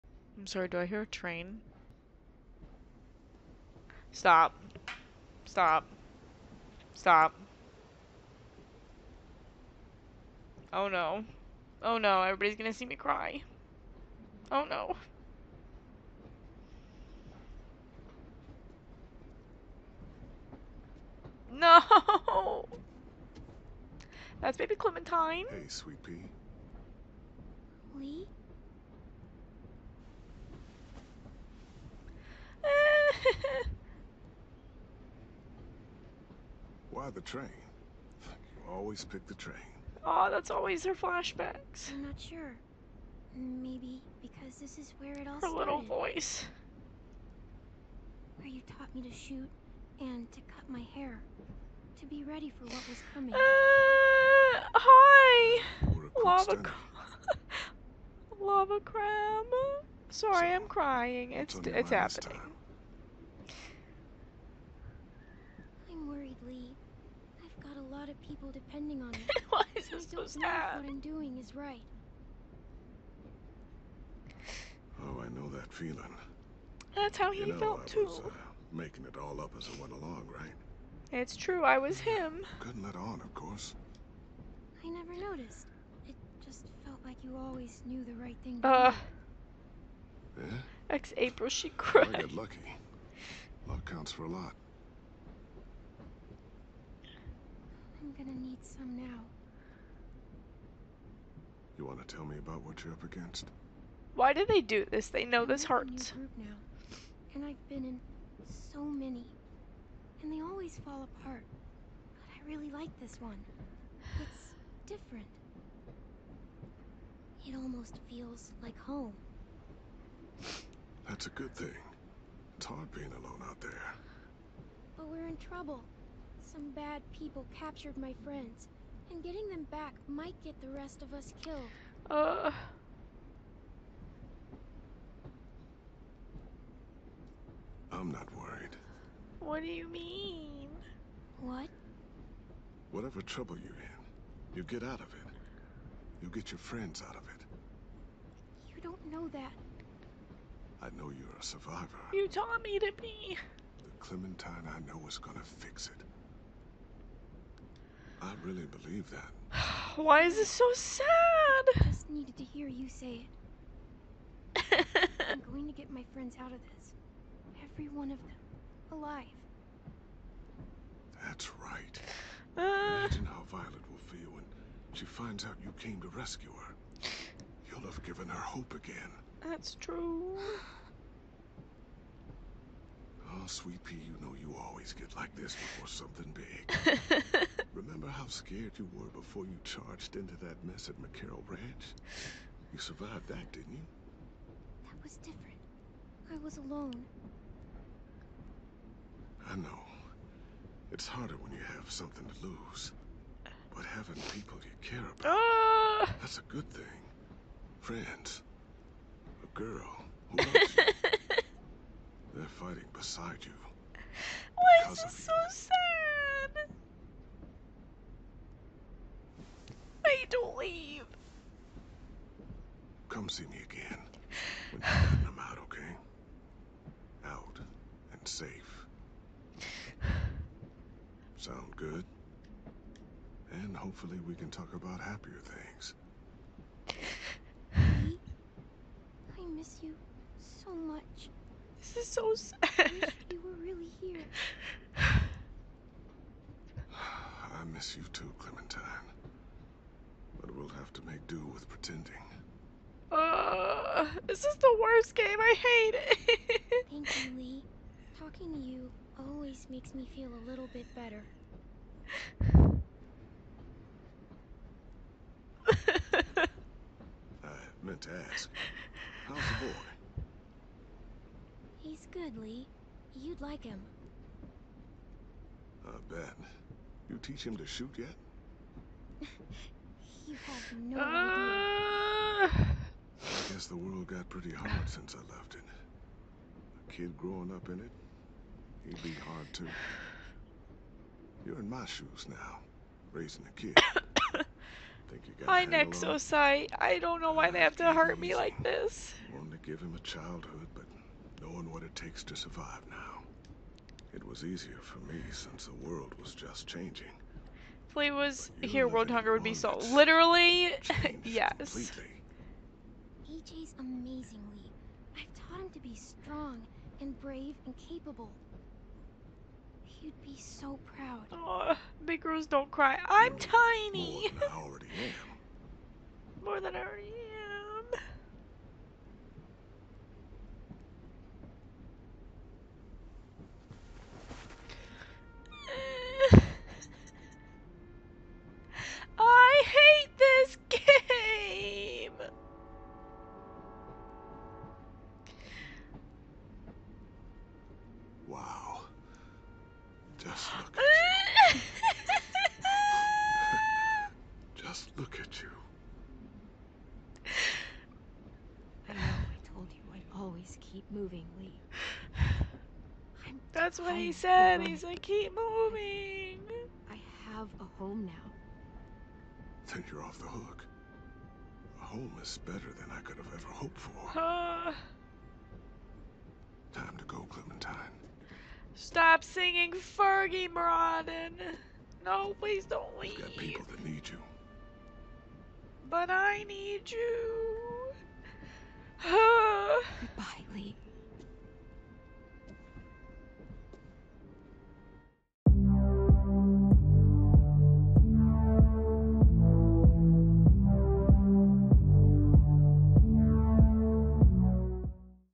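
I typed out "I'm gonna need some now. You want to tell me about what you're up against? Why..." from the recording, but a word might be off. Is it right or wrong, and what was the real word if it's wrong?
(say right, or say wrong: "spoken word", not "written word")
right.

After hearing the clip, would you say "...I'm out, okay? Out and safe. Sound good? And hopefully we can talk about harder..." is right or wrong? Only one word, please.
wrong.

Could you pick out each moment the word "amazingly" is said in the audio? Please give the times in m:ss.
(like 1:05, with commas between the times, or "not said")
5:13.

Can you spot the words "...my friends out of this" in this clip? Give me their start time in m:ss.
2:45.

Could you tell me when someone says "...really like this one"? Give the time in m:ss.
1:52.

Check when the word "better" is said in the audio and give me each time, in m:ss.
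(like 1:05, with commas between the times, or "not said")
4:20, 6:12.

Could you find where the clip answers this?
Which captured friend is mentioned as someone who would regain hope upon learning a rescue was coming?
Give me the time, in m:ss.
2:53.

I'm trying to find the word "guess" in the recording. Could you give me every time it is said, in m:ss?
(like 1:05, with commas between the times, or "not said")
4:43.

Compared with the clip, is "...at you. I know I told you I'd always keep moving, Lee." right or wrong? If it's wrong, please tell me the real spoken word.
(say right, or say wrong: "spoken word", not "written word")
right.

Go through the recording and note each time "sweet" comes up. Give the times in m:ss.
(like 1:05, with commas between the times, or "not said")
0:25, 3:03.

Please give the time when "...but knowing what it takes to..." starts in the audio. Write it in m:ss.
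5:00.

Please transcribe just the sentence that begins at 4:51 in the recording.
You're in my shoes now, raising a kid.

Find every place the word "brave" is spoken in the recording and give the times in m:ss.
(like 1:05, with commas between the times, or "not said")
5:17.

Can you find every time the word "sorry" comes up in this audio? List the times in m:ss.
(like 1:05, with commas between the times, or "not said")
0:00, 1:00.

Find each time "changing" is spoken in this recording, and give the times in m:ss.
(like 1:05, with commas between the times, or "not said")
5:06.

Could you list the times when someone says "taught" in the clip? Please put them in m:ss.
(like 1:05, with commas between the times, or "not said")
0:48, 2:32, 5:15.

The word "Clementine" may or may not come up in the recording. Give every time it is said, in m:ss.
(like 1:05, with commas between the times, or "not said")
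0:24, 2:33, 4:08, 6:17.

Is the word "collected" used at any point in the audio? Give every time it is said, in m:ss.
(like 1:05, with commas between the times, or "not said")
not said.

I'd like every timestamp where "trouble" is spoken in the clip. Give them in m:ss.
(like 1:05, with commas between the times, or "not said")
2:05, 2:23.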